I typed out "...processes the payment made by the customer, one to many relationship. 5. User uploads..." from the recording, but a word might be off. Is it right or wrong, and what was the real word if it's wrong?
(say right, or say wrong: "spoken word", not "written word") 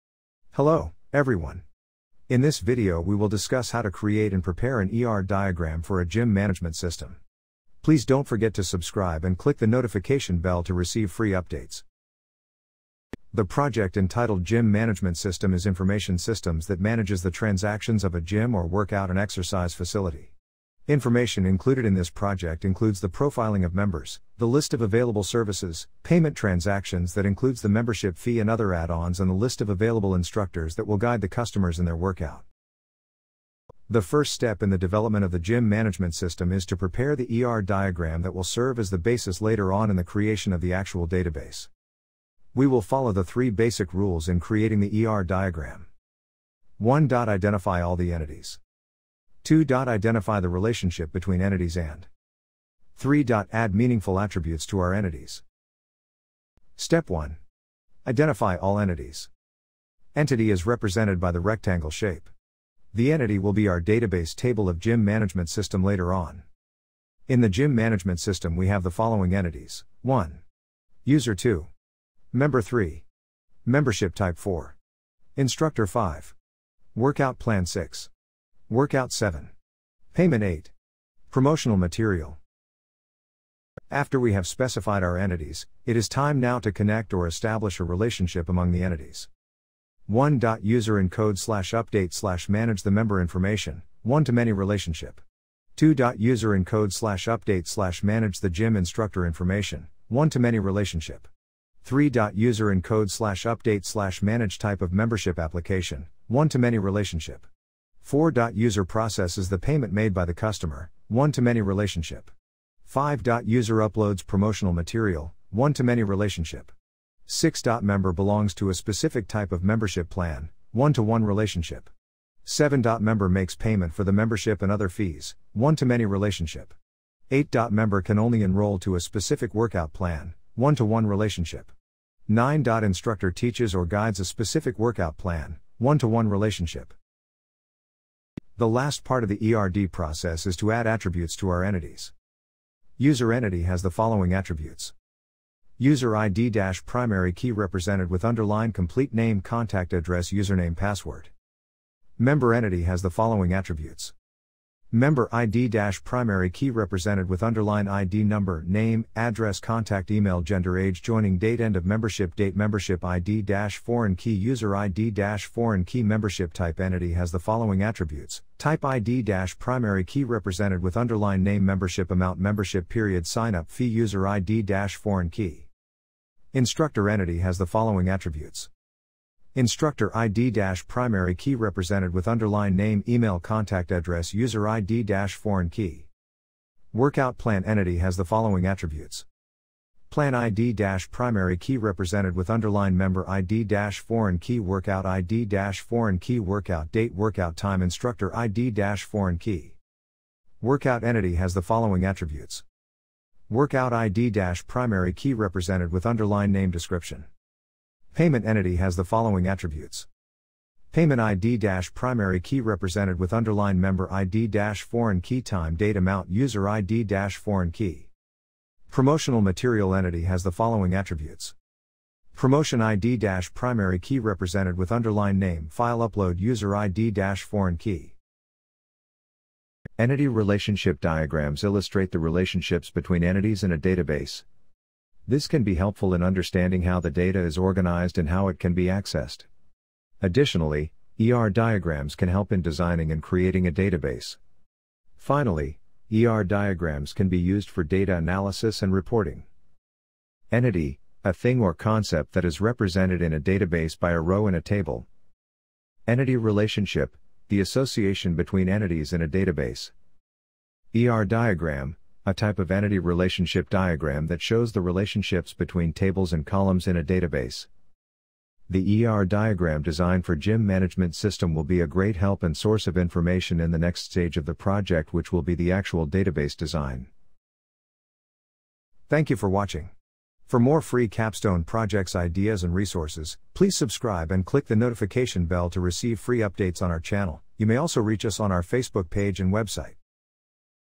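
right.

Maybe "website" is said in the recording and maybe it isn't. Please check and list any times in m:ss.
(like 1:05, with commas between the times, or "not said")
4:49.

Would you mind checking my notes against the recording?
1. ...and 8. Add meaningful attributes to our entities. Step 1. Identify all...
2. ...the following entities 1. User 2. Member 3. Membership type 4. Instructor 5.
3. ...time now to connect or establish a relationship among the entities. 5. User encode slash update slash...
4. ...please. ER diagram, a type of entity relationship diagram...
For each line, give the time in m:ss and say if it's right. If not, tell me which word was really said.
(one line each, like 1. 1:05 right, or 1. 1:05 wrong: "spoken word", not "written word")
1. 0:51 wrong: "3", not "8"
2. 1:08 right
3. 1:26 wrong: "1", not "5"
4. 4:19 wrong: "database", not "please".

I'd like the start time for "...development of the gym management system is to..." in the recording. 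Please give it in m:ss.
0:34.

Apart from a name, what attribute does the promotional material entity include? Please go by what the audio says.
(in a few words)
File upload.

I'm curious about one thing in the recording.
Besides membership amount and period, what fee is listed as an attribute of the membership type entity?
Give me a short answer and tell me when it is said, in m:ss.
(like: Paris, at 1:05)
Sign up fee, at 2:53.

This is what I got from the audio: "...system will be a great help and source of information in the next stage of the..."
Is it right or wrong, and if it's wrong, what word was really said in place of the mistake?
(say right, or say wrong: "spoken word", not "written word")
right.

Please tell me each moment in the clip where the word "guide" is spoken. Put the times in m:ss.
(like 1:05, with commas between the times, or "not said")
0:30, 2:13.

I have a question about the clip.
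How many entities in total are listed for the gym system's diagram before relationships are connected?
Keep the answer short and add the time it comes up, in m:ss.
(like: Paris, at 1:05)
8, at 1:20.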